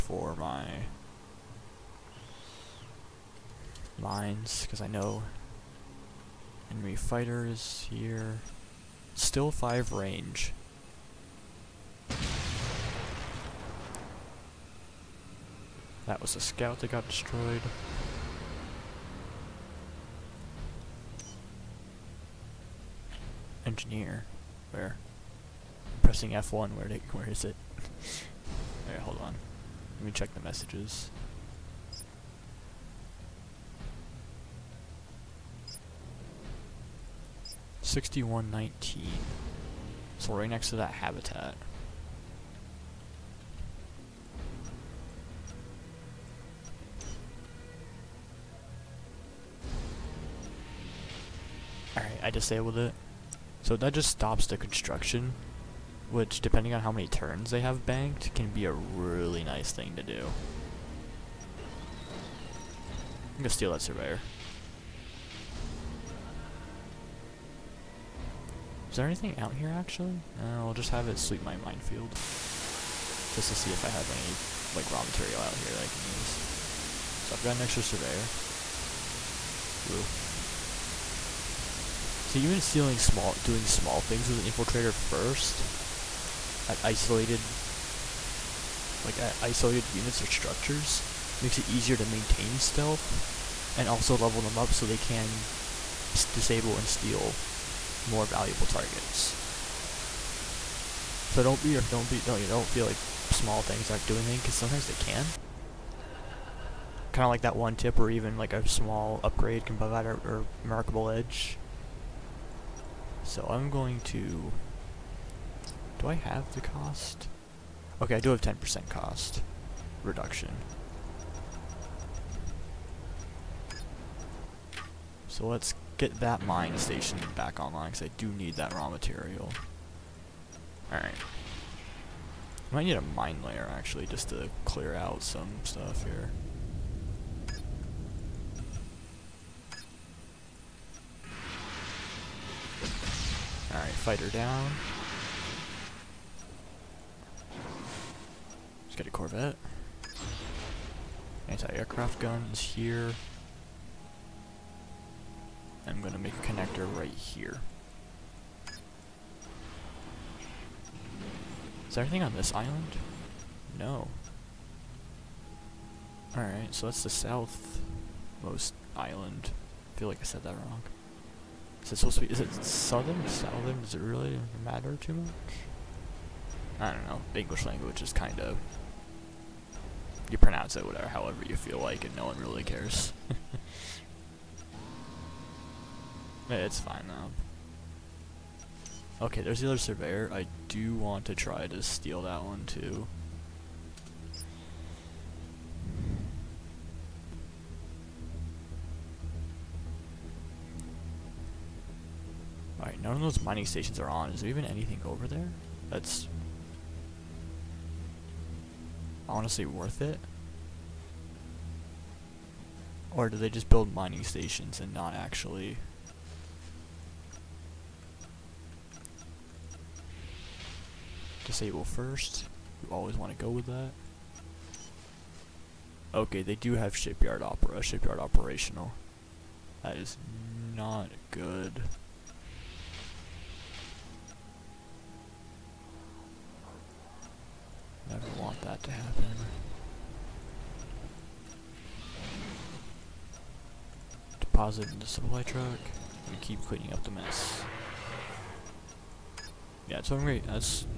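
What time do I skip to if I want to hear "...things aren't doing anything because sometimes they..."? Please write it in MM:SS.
01:43.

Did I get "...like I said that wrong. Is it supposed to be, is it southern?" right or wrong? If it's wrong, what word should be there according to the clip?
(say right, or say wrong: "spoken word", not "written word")
right.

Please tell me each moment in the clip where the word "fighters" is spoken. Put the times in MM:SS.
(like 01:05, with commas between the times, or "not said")
00:06, 02:23.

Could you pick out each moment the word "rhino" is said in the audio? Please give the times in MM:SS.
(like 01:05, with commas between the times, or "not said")
not said.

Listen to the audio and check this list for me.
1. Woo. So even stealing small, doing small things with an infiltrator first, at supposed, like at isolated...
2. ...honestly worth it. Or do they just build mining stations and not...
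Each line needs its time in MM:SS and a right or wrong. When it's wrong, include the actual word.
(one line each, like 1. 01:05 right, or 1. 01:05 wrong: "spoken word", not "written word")
1. 01:19 wrong: "isolated", not "supposed"
2. 03:29 right.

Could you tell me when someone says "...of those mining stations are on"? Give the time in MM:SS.
03:23.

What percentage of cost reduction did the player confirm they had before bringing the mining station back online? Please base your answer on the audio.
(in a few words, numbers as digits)
10%.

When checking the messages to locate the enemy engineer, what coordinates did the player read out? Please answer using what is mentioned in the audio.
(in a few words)
61 19.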